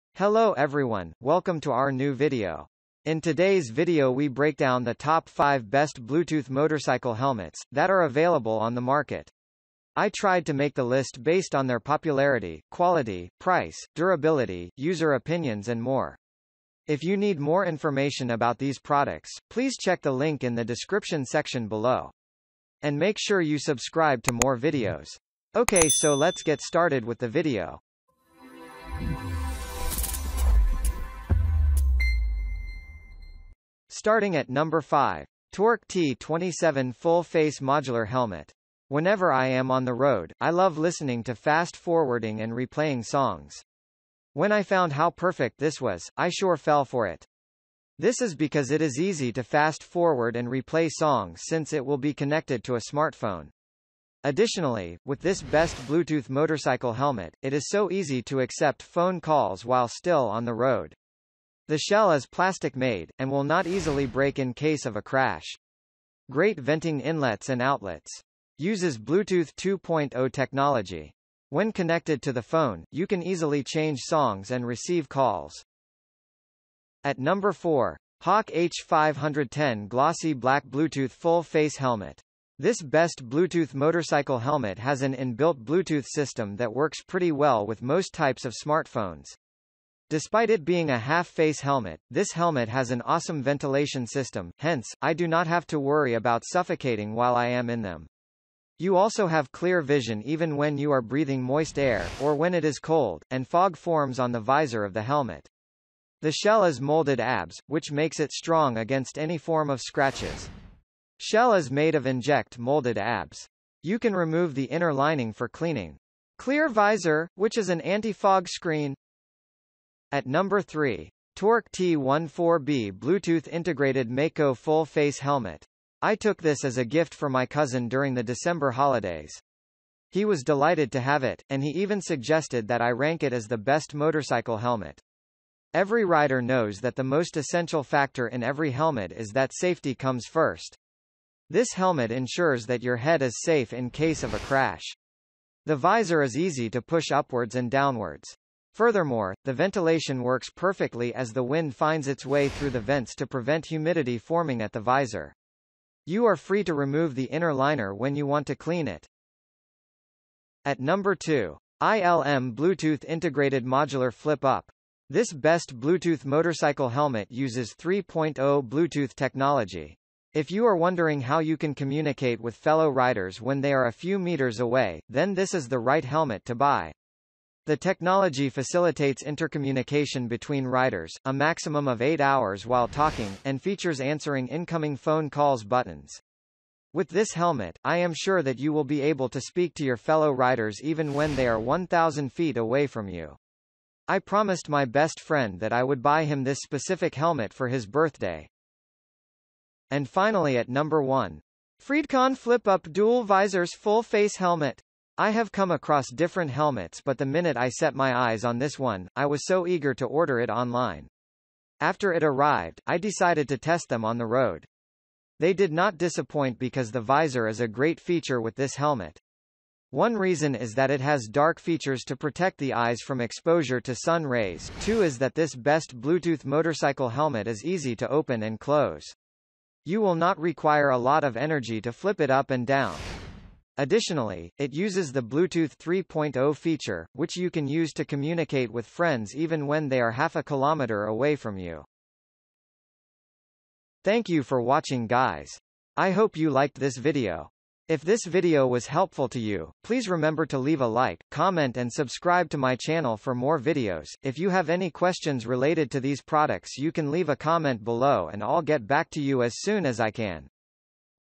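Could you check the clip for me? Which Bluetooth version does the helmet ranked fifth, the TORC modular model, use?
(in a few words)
Bluetooth 2.0.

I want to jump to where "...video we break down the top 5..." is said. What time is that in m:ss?
0:03.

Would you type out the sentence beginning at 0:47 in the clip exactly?
This is because it is easy to fast forward and replay songs since it will be connected to a smartphone.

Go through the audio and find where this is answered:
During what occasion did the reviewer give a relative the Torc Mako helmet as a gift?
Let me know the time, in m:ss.
2:08.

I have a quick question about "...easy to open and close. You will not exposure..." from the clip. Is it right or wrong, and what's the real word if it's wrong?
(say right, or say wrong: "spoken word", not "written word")
wrong: "require", not "exposure".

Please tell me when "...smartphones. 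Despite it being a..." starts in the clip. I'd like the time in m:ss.
1:28.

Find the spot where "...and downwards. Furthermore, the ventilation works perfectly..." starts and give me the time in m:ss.
2:27.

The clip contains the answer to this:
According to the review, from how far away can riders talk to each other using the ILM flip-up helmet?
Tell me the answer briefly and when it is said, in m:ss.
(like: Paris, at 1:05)
1,000 feet, at 3:11.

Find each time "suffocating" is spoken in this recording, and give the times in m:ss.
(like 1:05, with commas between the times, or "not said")
1:36.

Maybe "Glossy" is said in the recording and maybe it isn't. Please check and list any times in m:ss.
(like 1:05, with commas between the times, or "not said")
1:19.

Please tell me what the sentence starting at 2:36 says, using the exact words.
You are free to remove the inner liner when you want to clean it.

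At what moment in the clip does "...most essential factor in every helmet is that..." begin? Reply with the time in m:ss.
2:17.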